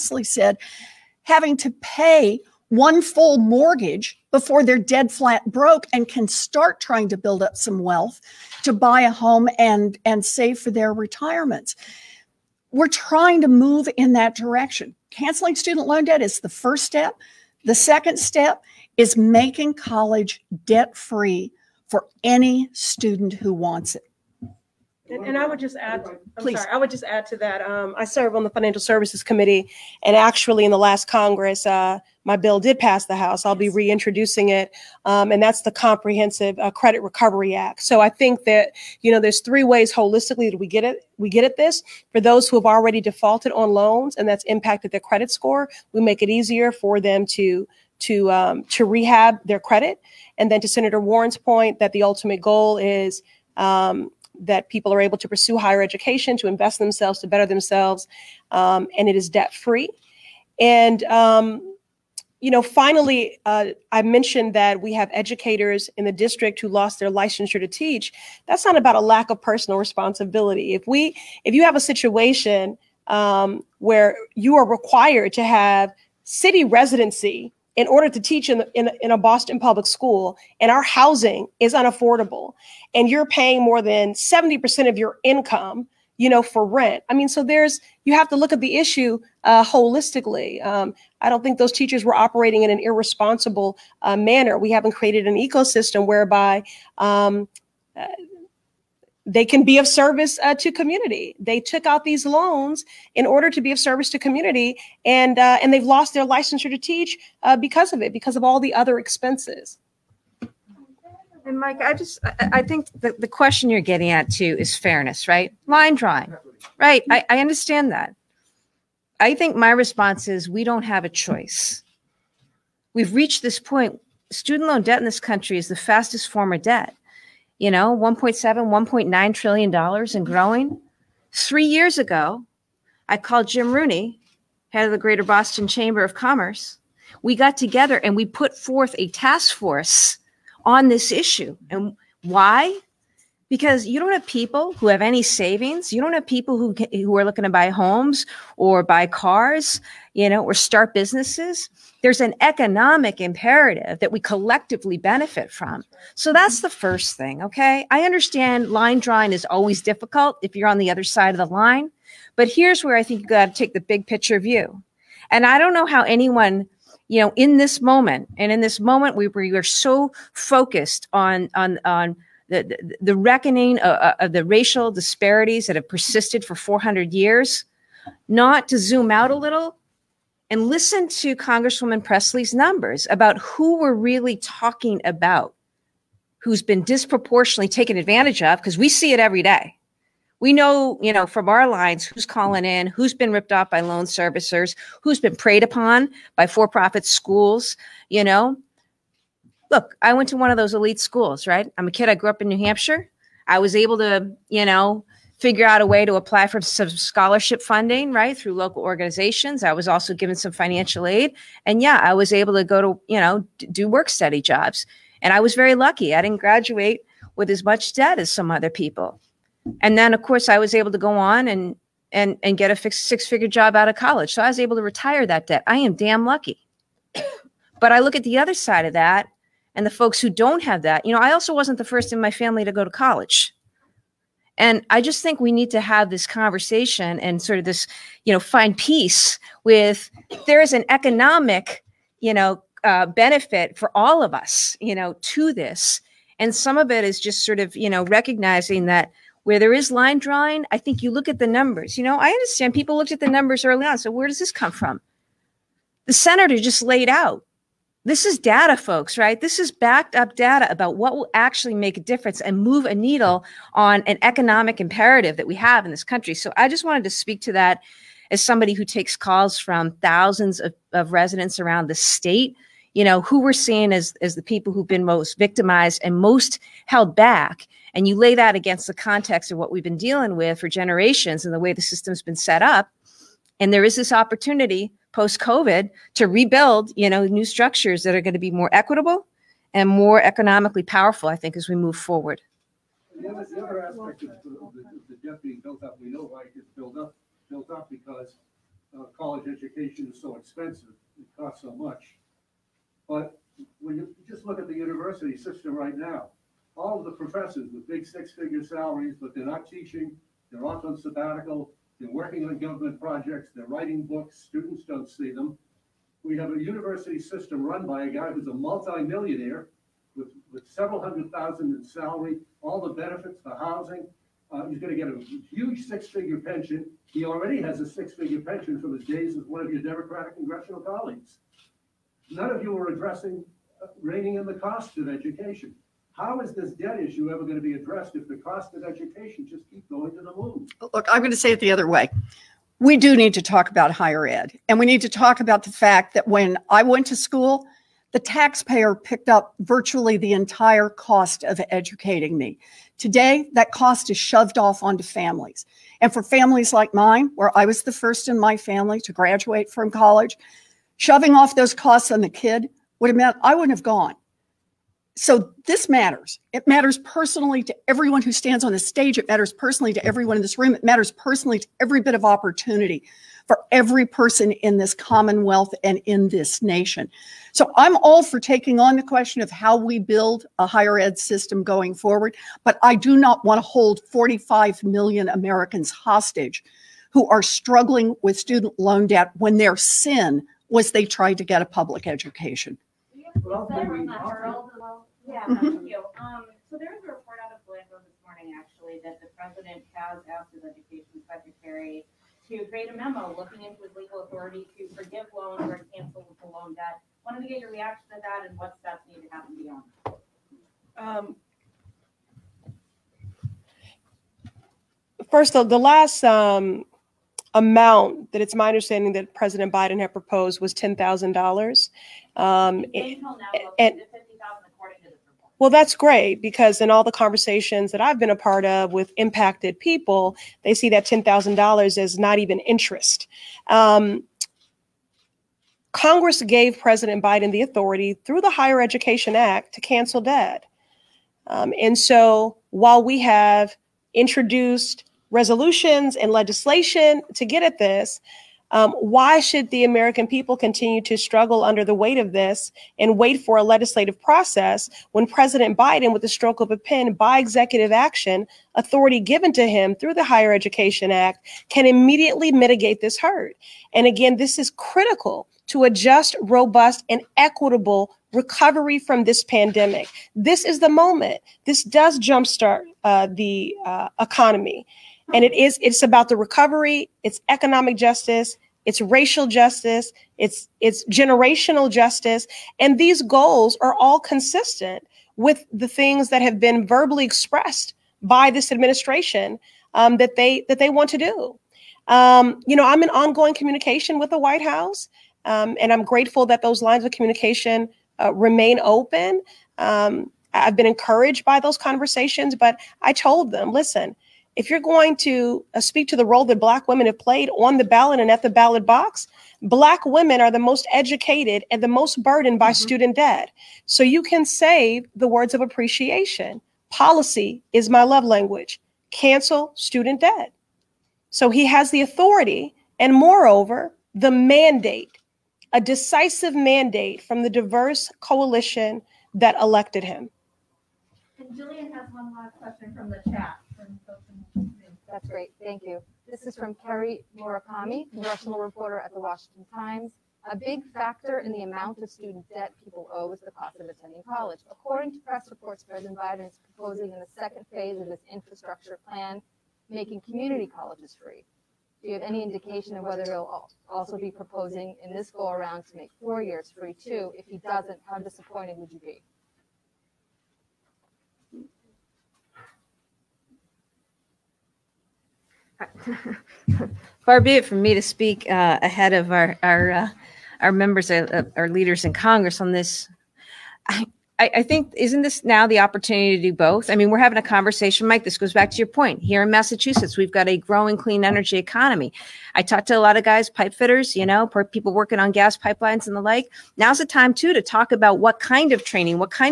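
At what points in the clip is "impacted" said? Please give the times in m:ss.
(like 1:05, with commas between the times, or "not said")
0:44, 7:09.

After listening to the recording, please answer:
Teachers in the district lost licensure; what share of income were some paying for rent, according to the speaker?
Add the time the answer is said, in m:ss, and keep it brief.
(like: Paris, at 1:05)
more than 70%, at 1:23.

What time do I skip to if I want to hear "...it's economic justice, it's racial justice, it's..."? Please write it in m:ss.
7:57.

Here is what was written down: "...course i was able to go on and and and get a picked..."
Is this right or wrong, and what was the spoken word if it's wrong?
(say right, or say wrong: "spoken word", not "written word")
wrong: "fixed", not "picked".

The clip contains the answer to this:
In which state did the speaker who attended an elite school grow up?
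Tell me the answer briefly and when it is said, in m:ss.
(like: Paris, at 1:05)
New Hampshire, at 3:22.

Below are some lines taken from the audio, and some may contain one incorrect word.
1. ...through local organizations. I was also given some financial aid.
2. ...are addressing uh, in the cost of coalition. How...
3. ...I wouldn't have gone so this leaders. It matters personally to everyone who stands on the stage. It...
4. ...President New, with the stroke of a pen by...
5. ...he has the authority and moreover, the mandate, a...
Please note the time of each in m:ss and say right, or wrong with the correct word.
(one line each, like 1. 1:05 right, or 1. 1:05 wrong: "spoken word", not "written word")
1. 3:28 right
2. 5:32 wrong: "education", not "coalition"
3. 6:03 wrong: "matters", not "leaders"
4. 7:35 wrong: "Biden", not "New"
5. 8:41 right.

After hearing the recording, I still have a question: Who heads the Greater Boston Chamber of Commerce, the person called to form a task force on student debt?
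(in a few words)
Jim Rooney.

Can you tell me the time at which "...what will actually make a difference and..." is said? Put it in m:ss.
4:20.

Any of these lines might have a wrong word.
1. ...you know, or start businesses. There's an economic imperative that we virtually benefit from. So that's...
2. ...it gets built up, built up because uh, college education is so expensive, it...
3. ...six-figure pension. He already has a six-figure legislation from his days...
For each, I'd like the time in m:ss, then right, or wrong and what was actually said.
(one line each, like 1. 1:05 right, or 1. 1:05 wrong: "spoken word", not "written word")
1. 2:30 wrong: "collectively", not "virtually"
2. 4:56 right
3. 5:25 wrong: "pension", not "legislation".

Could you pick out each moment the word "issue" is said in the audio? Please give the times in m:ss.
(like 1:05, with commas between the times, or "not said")
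1:28, 2:21, 5:37.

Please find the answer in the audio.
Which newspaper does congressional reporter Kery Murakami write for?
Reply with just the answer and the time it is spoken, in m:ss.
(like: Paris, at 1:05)
Washington Times, at 8:59.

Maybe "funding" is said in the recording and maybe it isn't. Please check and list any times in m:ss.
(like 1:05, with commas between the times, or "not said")
3:27.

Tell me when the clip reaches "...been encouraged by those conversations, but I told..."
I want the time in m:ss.
8:20.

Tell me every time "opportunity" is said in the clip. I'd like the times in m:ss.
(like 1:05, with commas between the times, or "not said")
4:44, 6:12, 9:35.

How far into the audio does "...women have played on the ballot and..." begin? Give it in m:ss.
8:26.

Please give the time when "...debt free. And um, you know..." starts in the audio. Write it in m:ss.
0:59.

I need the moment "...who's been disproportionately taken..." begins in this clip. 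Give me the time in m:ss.
3:06.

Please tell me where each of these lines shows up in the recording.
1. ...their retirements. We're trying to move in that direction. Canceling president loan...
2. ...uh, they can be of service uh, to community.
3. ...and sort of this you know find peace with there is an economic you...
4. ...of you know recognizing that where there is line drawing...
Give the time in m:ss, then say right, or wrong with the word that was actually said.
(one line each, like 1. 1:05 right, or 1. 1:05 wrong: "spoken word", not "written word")
1. 0:10 wrong: "student", not "president"
2. 1:37 right
3. 3:57 right
4. 4:07 right.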